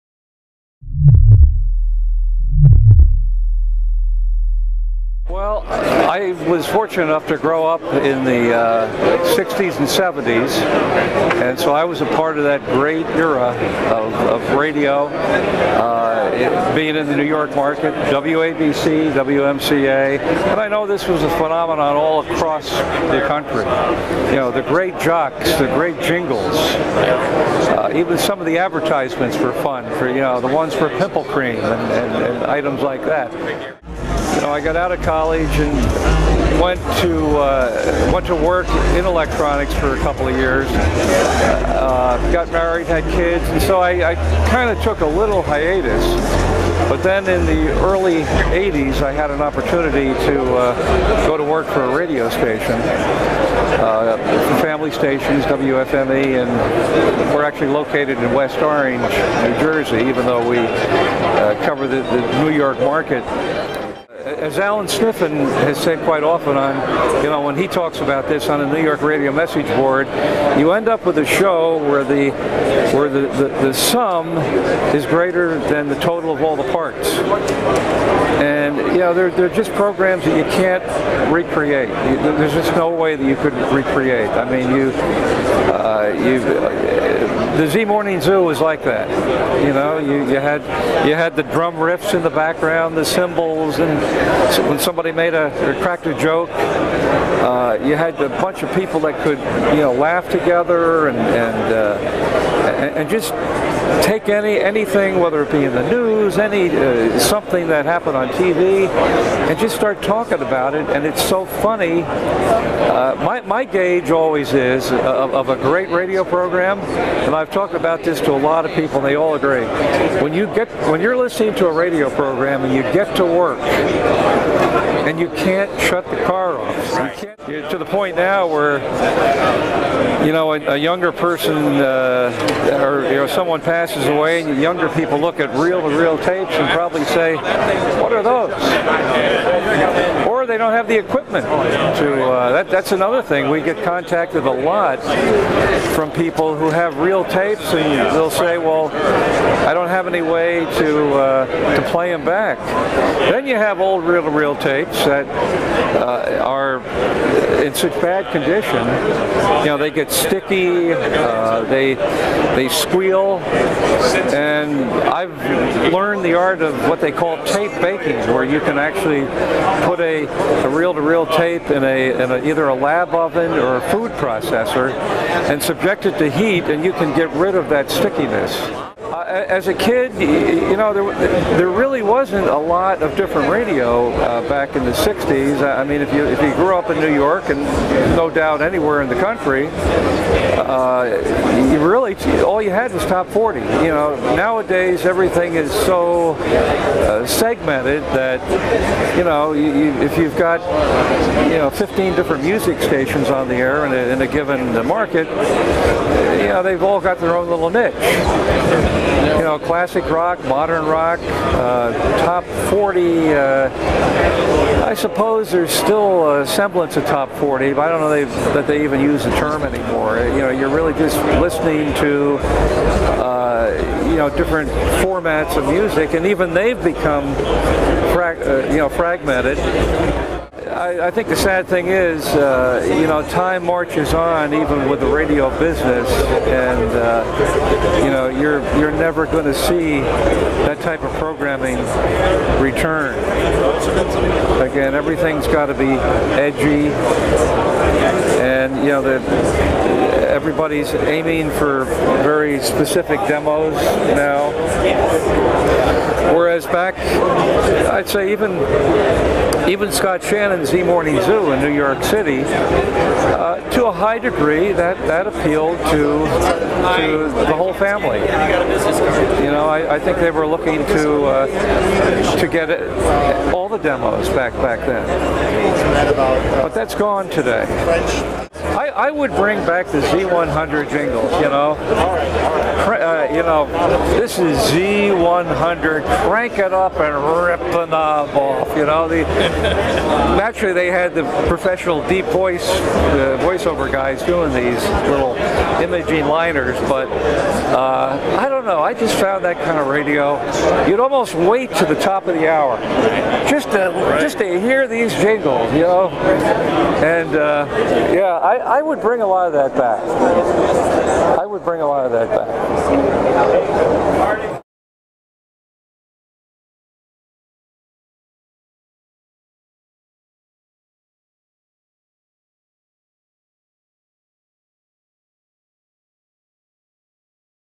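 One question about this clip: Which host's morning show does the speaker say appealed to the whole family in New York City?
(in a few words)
Scott Shannon.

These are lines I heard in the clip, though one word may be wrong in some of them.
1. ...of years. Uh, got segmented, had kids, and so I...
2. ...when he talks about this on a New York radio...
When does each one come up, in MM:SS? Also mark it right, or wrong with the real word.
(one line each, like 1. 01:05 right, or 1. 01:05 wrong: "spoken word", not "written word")
1. 00:40 wrong: "married", not "segmented"
2. 01:07 right.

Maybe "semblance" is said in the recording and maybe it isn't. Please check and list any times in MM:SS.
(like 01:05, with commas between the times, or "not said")
03:36.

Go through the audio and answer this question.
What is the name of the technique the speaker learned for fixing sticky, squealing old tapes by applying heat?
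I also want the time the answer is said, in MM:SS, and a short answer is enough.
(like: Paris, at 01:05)
tape baking, at 02:47.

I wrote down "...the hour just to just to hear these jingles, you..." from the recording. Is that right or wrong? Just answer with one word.
right.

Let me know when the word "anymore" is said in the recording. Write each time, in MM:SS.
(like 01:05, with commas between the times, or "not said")
03:39.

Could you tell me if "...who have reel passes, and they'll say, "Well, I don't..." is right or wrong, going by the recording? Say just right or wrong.
wrong.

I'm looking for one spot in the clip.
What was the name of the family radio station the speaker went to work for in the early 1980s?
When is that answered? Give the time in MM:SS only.
00:55.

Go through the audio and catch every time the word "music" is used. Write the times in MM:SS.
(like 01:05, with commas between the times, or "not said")
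03:22, 03:45.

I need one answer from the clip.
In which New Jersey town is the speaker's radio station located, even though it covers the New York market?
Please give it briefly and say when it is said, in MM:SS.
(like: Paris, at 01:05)
West Orange, at 00:58.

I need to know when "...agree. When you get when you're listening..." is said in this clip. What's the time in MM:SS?
01:59.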